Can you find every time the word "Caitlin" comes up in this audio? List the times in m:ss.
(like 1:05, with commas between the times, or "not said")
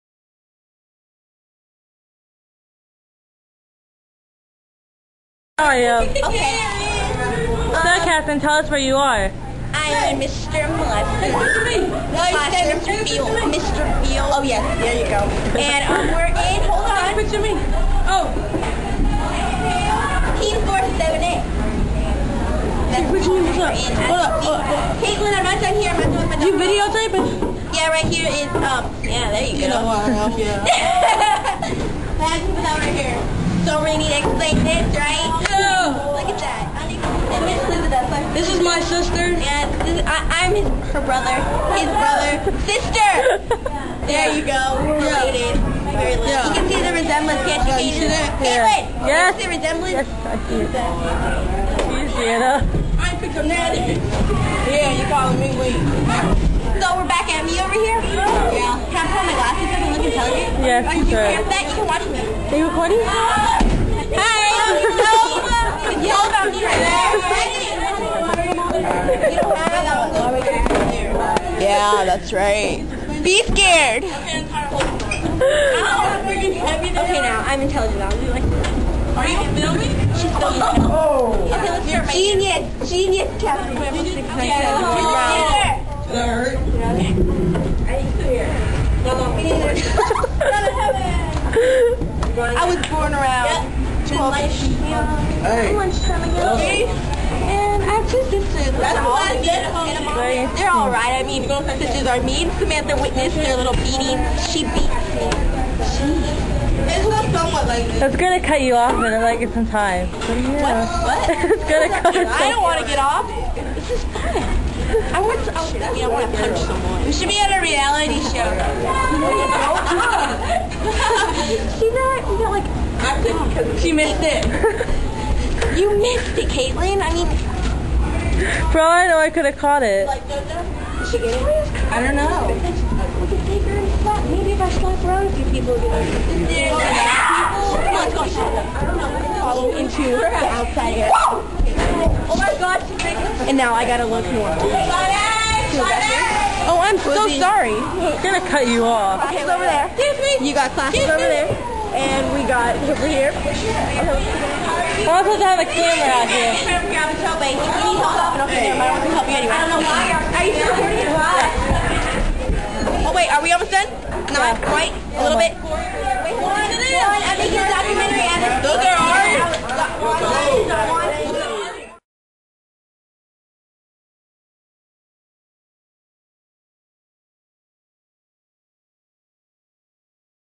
0:24, 0:48, 2:06.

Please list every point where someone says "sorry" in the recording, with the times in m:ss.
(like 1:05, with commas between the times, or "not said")
2:27.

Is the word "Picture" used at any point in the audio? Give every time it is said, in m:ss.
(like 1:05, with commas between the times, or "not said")
0:17.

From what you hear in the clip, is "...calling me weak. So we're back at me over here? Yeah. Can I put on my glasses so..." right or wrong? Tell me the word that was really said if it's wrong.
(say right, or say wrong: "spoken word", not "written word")
right.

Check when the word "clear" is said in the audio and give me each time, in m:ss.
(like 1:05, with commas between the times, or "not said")
1:28.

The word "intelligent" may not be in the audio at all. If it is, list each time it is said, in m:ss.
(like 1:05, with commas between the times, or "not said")
1:00, 1:17.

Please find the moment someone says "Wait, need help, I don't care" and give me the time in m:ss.
2:36.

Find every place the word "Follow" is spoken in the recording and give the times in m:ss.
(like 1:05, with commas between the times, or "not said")
2:19.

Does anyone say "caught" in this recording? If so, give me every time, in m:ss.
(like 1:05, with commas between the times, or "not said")
2:09.